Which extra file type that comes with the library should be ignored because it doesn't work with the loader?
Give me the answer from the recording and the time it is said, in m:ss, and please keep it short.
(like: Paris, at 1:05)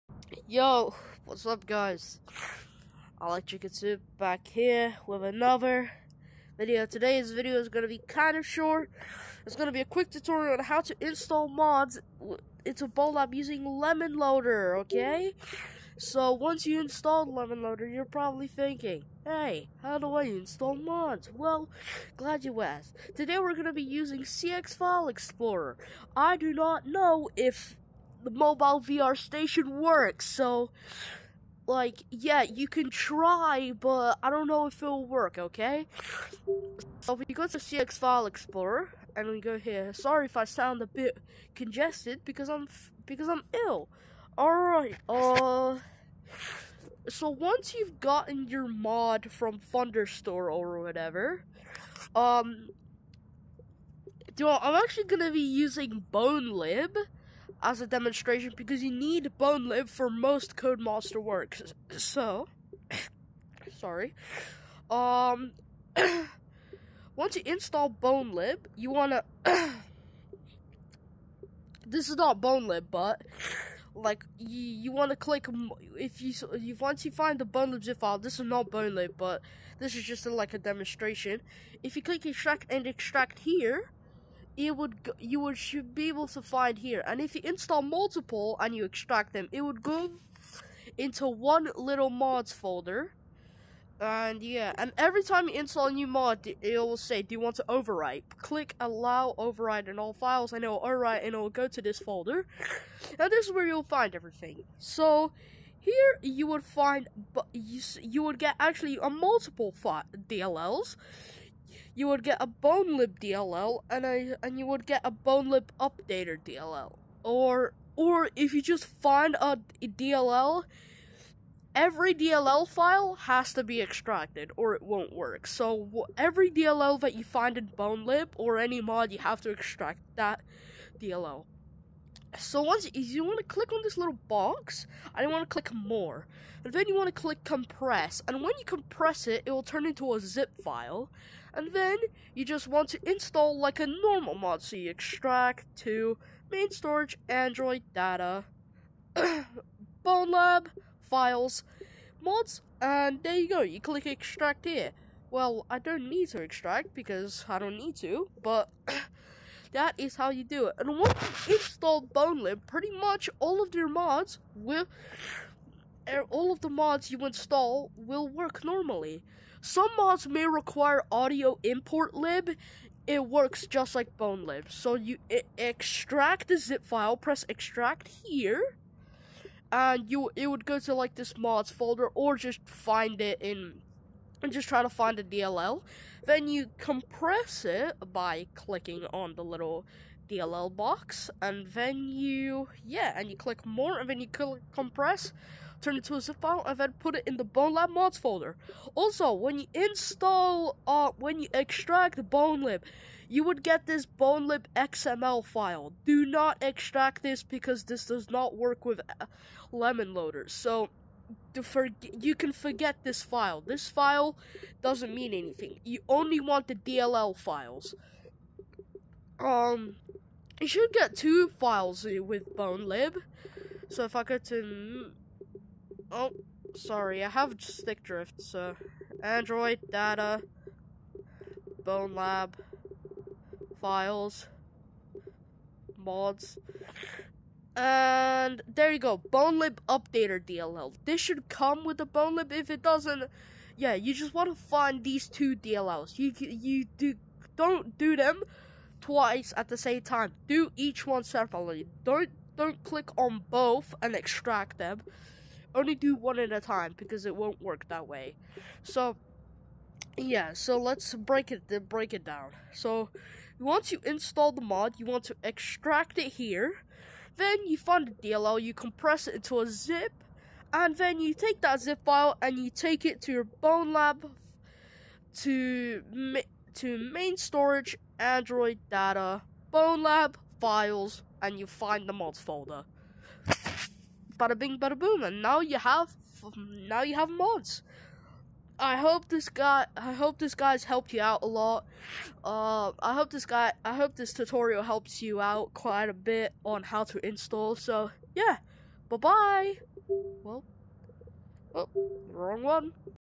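XML, at 3:24.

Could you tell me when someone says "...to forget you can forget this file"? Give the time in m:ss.
3:31.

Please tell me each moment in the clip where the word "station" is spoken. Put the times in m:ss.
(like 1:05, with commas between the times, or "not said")
0:29.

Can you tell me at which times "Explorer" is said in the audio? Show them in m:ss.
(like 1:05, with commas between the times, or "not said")
0:25, 0:38.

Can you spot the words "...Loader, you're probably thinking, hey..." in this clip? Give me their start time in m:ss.
0:17.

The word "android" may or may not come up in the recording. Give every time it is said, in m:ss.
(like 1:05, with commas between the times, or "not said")
2:27, 3:49, 4:38.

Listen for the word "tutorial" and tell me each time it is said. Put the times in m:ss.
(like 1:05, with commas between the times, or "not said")
0:10, 4:54.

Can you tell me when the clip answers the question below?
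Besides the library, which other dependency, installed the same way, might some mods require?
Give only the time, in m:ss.
2:51.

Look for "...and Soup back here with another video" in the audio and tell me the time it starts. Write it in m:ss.
0:03.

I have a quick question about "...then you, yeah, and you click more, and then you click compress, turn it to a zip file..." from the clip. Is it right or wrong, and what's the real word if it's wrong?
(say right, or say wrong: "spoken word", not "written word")
right.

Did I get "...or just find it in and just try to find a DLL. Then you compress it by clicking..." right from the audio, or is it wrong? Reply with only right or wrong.
right.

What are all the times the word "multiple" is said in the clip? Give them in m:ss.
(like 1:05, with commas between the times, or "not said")
1:27, 1:49.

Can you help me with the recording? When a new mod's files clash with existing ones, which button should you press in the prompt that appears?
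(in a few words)
Allow Overwrite.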